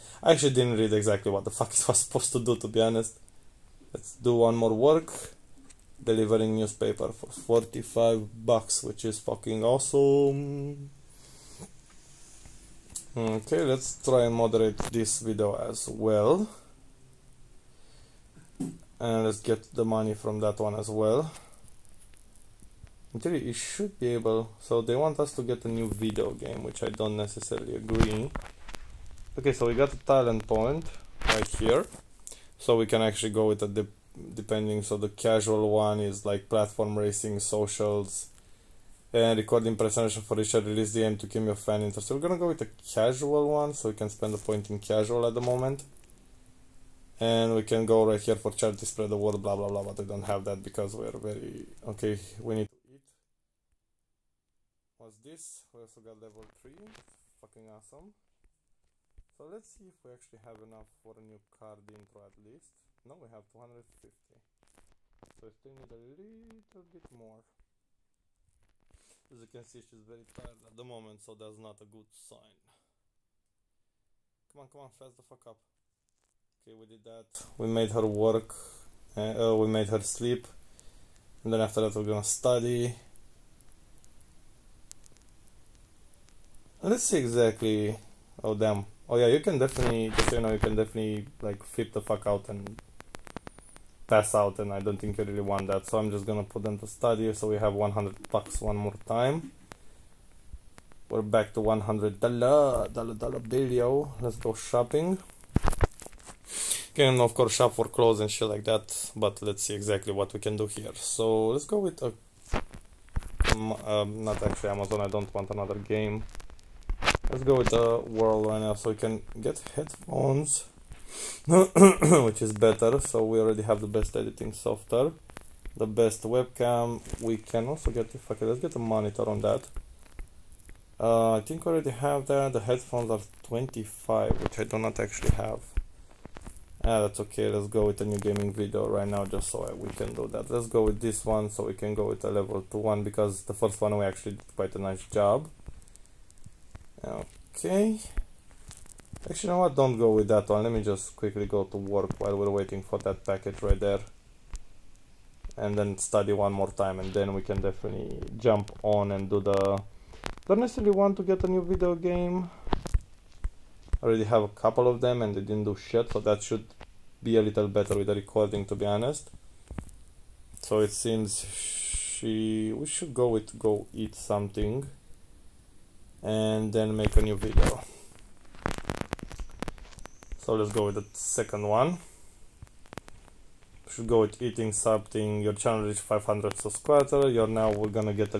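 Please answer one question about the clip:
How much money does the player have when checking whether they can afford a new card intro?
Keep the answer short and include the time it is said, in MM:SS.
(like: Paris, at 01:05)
250, at 01:03.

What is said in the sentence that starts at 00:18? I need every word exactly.
And let's get the money from that one as well.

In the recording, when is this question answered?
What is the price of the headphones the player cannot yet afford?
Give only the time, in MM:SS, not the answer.
02:13.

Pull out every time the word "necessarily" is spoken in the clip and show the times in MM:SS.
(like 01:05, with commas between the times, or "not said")
00:27, 02:40.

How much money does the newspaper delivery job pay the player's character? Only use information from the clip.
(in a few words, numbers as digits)
$45.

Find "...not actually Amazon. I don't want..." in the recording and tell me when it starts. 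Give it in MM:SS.
01:54.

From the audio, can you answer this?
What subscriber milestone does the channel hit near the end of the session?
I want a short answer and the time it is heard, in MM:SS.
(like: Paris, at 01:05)
500 subscribers, at 03:06.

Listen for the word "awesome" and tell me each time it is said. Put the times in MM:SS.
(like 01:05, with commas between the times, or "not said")
00:09, 00:57.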